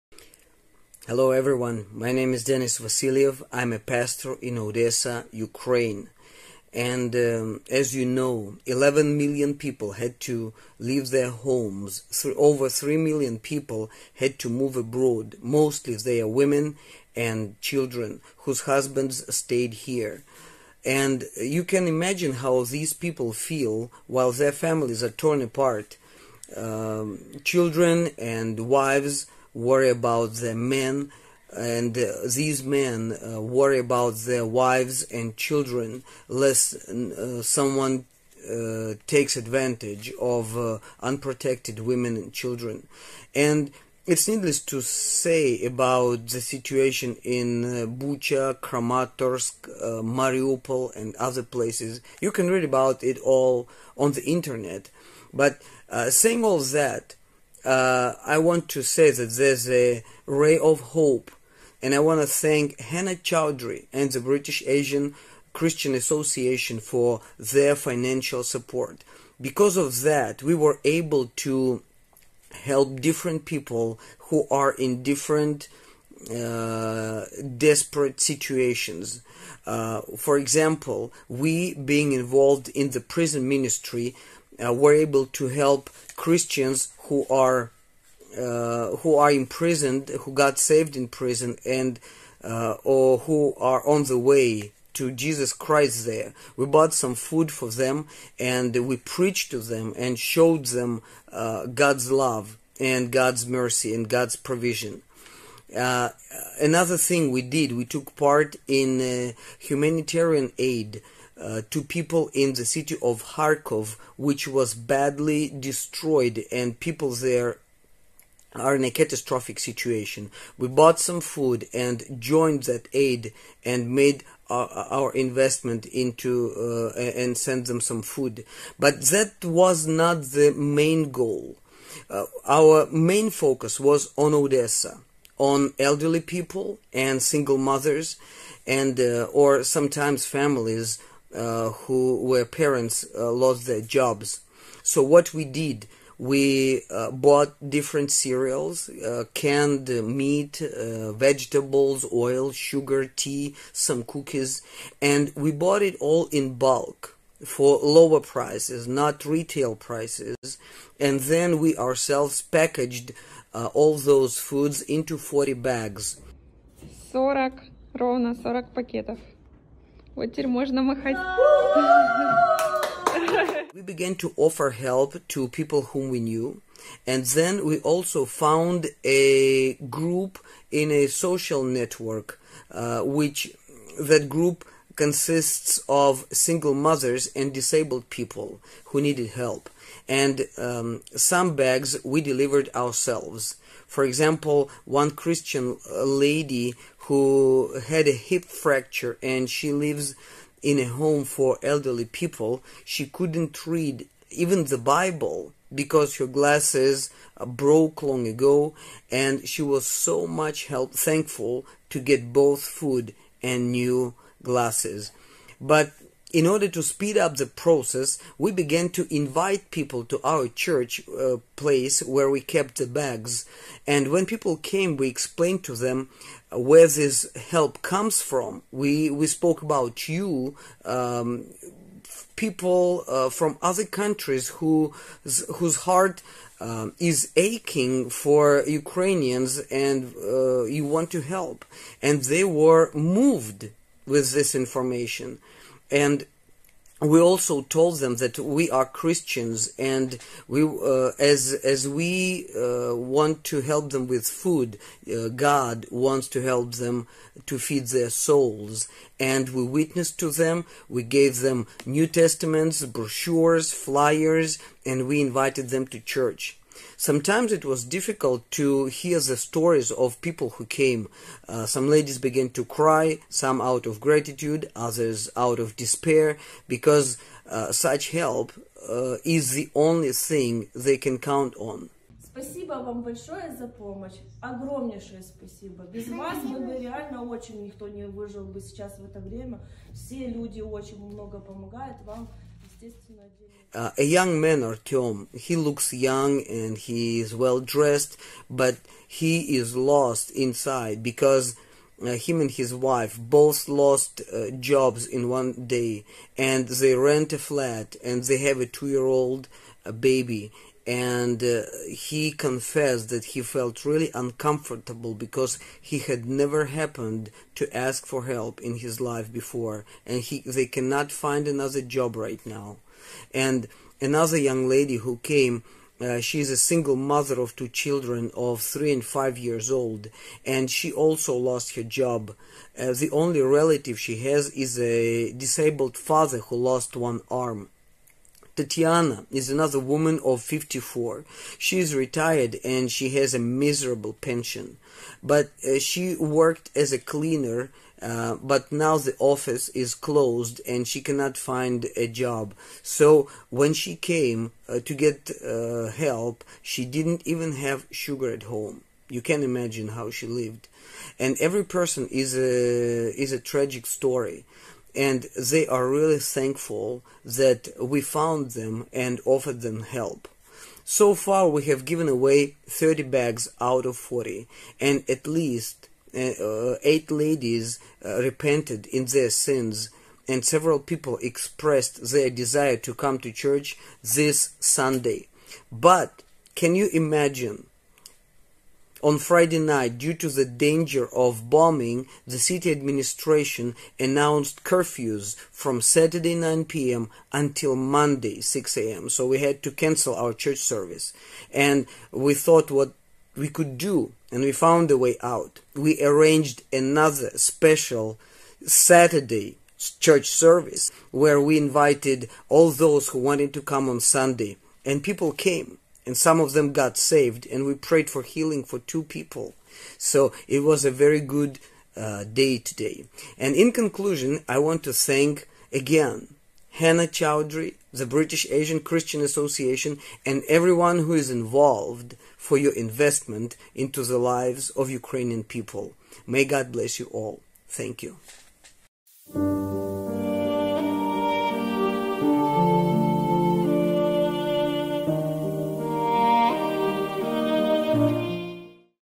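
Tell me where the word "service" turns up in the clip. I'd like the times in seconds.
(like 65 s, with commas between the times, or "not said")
400 s, 410 s.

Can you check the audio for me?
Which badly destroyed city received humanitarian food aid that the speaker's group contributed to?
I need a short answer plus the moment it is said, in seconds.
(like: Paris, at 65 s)
Kharkov, at 113 s.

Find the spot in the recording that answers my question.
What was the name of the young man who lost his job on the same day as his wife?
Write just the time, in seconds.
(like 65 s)
294 s.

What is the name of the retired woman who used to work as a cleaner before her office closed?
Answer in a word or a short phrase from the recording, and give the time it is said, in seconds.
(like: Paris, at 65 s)
Tatiana, at 338 s.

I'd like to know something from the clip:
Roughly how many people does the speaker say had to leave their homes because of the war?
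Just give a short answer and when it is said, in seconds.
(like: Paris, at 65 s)
11 million, at 8 s.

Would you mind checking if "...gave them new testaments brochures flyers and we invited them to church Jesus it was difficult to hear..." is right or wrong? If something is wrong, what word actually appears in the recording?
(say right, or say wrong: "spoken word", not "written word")
wrong: "Sometimes", not "Jesus".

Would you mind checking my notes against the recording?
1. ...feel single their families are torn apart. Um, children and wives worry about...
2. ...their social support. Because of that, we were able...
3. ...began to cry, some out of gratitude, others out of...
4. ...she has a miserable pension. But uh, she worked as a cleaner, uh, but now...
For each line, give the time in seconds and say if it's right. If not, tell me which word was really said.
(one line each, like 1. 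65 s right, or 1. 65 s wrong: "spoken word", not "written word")
1. 23 s wrong: "while", not "single"
2. 67 s wrong: "financial", not "social"
3. 272 s right
4. 342 s right.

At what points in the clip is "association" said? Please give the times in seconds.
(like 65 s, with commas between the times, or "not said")
65 s, 429 s.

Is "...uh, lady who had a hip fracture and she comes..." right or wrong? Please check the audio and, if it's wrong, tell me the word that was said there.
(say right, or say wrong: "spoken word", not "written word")
wrong: "lives", not "comes".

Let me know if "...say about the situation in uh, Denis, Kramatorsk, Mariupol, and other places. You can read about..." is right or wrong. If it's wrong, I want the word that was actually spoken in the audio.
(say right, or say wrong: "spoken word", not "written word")
wrong: "Bucha", not "Denis".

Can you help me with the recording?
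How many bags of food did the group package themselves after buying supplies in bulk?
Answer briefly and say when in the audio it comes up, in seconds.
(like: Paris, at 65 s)
40, at 165 s.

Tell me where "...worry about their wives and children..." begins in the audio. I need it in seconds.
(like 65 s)
33 s.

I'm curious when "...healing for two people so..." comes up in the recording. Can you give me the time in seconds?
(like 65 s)
418 s.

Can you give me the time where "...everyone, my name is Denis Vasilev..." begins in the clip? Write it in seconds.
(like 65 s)
1 s.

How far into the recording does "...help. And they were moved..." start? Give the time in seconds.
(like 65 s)
241 s.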